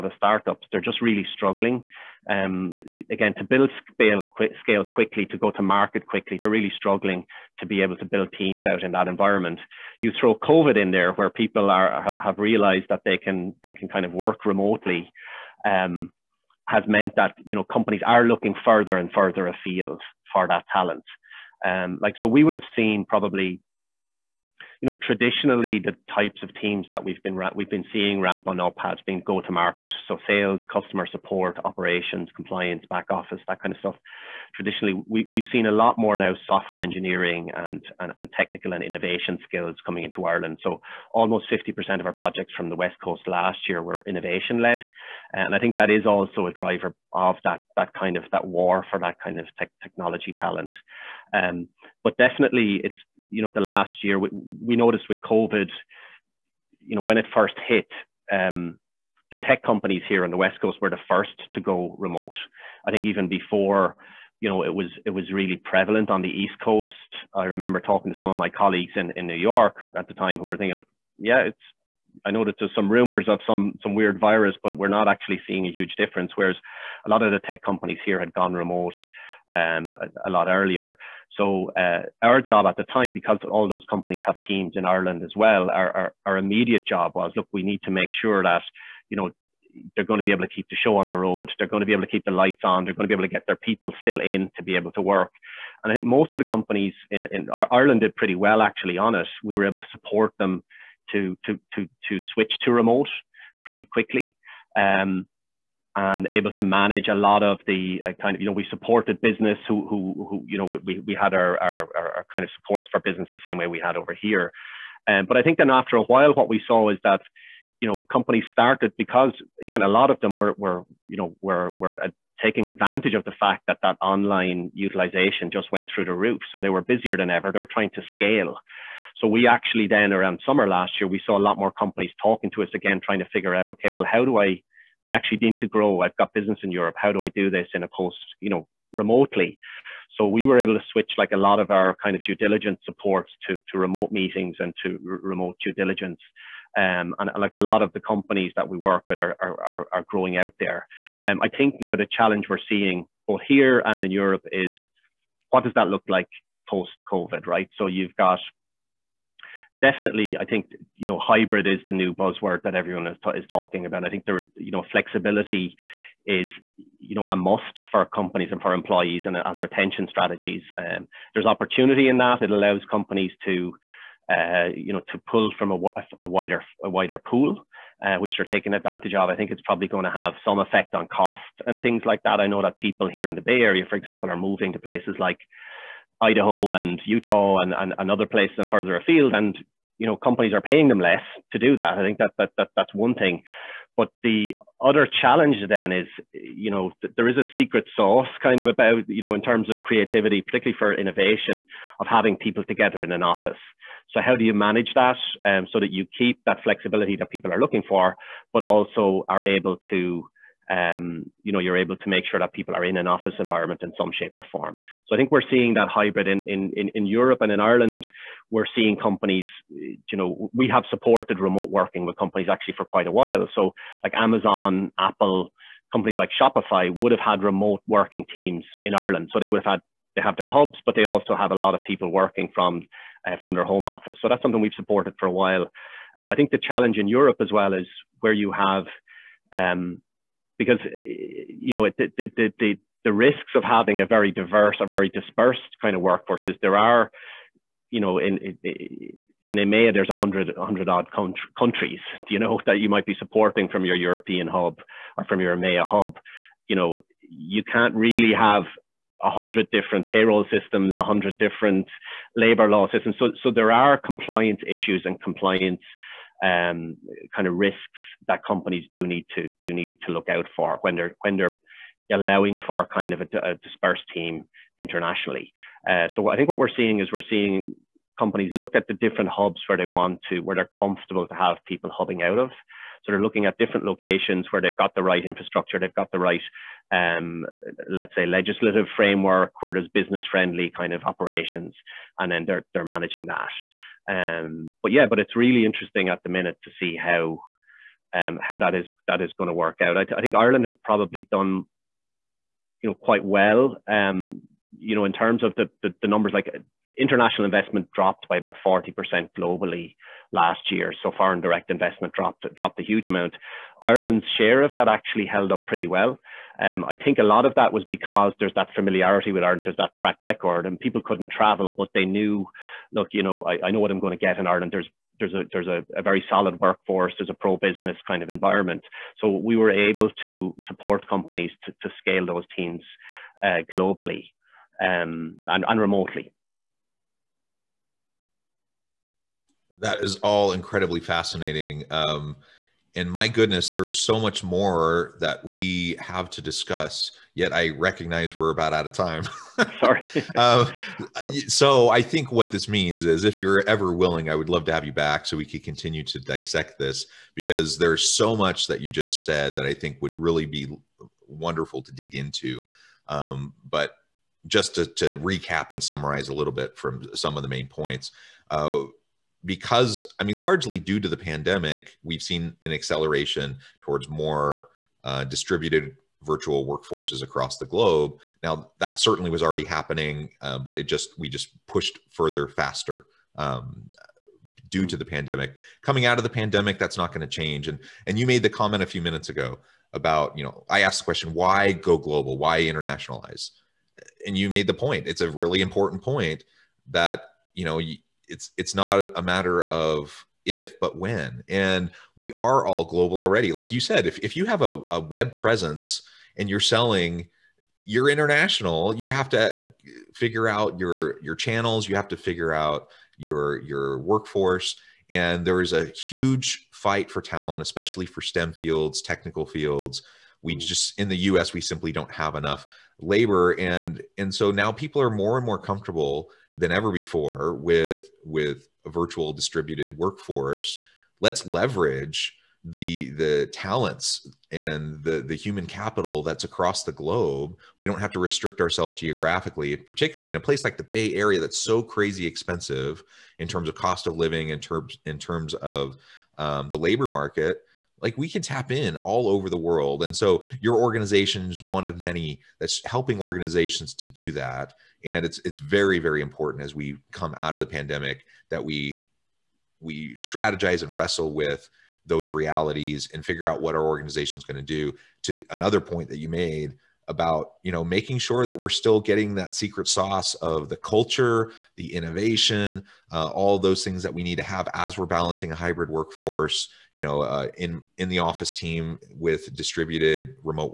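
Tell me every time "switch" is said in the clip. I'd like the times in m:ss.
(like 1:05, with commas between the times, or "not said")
1:42, 2:20.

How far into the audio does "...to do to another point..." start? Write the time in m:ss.
7:44.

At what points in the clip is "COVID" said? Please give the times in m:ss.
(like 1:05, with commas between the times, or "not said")
0:10, 0:55, 2:37.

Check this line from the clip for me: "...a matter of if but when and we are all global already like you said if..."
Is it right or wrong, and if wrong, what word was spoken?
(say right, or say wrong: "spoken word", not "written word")
right.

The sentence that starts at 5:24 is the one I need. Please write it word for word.
There's there's a there's a, a very solid workforce, there's a pro business kind of environment.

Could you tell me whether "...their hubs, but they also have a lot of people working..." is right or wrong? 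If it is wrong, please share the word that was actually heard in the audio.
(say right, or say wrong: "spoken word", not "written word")
right.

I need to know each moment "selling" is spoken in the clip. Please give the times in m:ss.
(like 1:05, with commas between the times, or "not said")
6:46.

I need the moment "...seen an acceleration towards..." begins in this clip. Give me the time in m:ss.
6:12.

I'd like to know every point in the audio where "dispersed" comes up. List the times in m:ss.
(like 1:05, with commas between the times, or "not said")
4:05, 4:33.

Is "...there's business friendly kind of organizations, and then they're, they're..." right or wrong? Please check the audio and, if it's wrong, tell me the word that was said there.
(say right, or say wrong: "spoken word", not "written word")
wrong: "operations", not "organizations".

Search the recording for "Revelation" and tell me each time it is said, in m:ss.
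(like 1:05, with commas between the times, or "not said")
not said.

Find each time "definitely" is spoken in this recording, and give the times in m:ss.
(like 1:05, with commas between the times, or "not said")
0:52, 2:39.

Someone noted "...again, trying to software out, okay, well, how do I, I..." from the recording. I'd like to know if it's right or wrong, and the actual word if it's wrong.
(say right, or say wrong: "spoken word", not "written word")
wrong: "figure", not "software".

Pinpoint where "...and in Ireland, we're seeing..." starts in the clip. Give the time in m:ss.
3:37.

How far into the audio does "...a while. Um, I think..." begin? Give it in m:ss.
3:55.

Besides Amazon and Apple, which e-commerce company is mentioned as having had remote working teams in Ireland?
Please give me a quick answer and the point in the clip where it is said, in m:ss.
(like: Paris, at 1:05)
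Shopify, at 3:46.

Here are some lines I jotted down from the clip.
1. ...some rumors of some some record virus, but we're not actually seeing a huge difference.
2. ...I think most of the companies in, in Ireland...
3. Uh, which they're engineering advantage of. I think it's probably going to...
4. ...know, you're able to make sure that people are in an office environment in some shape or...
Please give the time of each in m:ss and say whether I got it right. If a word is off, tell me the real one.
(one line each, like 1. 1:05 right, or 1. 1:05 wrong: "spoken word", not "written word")
1. 1:12 wrong: "weird", not "record"
2. 1:35 right
3. 2:58 wrong: "taking", not "engineering"
4. 3:31 right.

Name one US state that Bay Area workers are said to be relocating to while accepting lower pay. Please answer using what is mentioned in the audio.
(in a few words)
Idaho.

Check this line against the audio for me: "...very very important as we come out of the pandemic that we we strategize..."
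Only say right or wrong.
right.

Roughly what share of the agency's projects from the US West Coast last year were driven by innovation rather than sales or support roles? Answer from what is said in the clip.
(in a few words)
50%.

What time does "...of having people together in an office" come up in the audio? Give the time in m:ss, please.
3:21.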